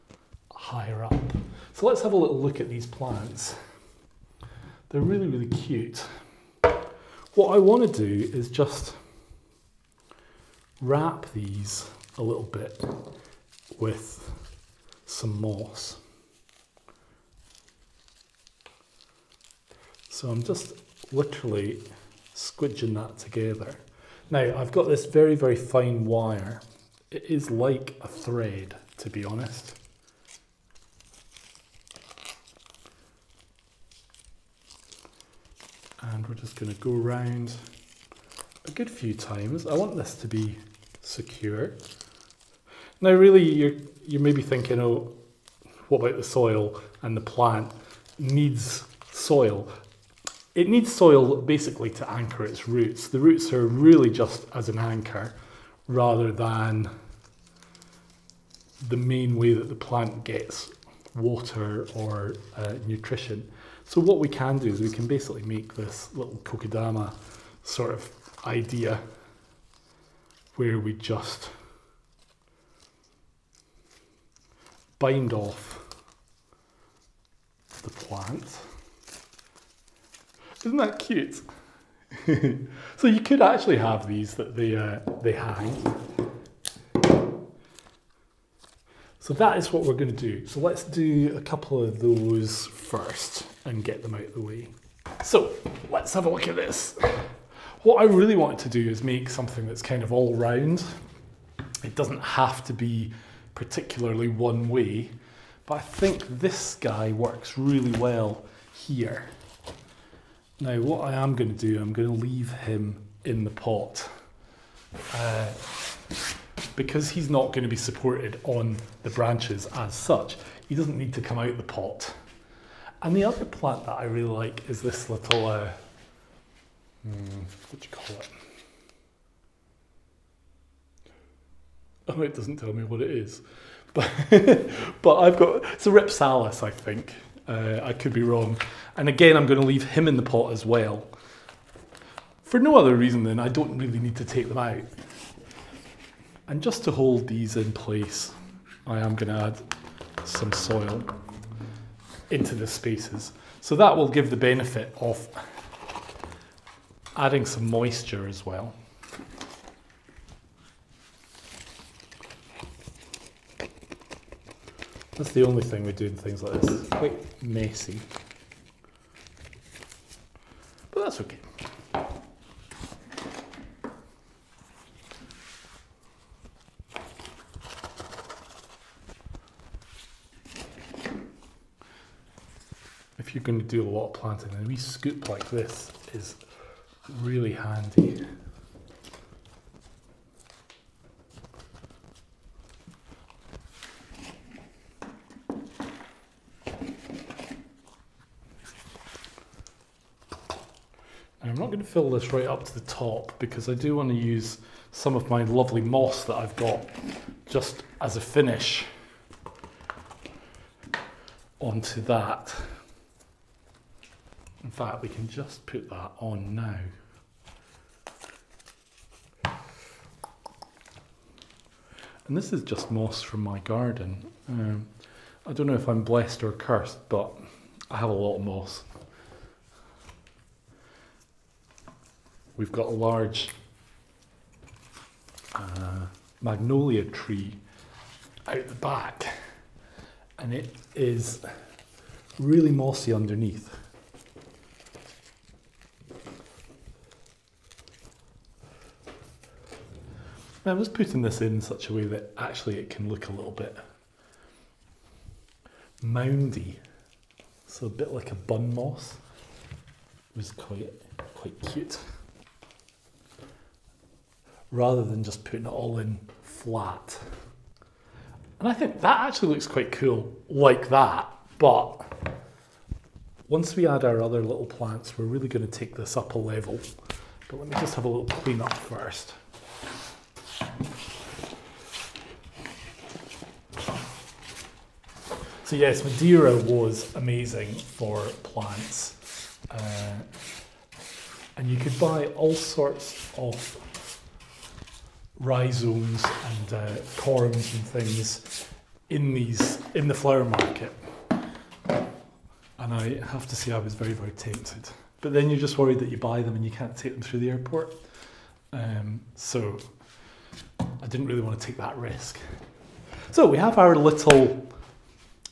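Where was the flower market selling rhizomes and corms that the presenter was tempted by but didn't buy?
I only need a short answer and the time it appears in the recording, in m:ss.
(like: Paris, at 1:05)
Madeira, at 4:46.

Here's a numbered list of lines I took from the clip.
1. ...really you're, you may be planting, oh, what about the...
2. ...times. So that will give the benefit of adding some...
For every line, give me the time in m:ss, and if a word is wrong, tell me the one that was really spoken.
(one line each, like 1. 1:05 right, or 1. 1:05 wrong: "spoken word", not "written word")
1. 0:43 wrong: "thinking", not "planting"
2. 2:32 wrong: "spaces", not "times".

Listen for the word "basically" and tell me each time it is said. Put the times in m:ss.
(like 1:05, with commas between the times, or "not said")
0:51, 1:05.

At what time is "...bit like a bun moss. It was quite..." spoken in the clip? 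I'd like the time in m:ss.
4:17.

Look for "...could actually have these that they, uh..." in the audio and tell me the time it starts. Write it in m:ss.
1:23.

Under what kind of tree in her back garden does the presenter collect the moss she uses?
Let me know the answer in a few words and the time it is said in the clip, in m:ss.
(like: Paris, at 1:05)
Magnolia, at 3:56.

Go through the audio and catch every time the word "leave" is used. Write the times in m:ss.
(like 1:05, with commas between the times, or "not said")
1:52, 2:19.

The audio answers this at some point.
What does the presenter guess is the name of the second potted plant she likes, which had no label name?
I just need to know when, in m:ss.
2:15.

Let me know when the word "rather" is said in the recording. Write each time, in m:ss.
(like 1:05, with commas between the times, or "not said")
0:55, 4:24.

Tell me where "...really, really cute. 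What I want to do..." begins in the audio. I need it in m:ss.
0:05.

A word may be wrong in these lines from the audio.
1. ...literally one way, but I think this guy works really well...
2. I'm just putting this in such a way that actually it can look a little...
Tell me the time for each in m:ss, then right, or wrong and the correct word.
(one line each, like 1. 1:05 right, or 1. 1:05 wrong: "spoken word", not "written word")
1. 1:43 wrong: "particularly", not "literally"
2. 4:10 right.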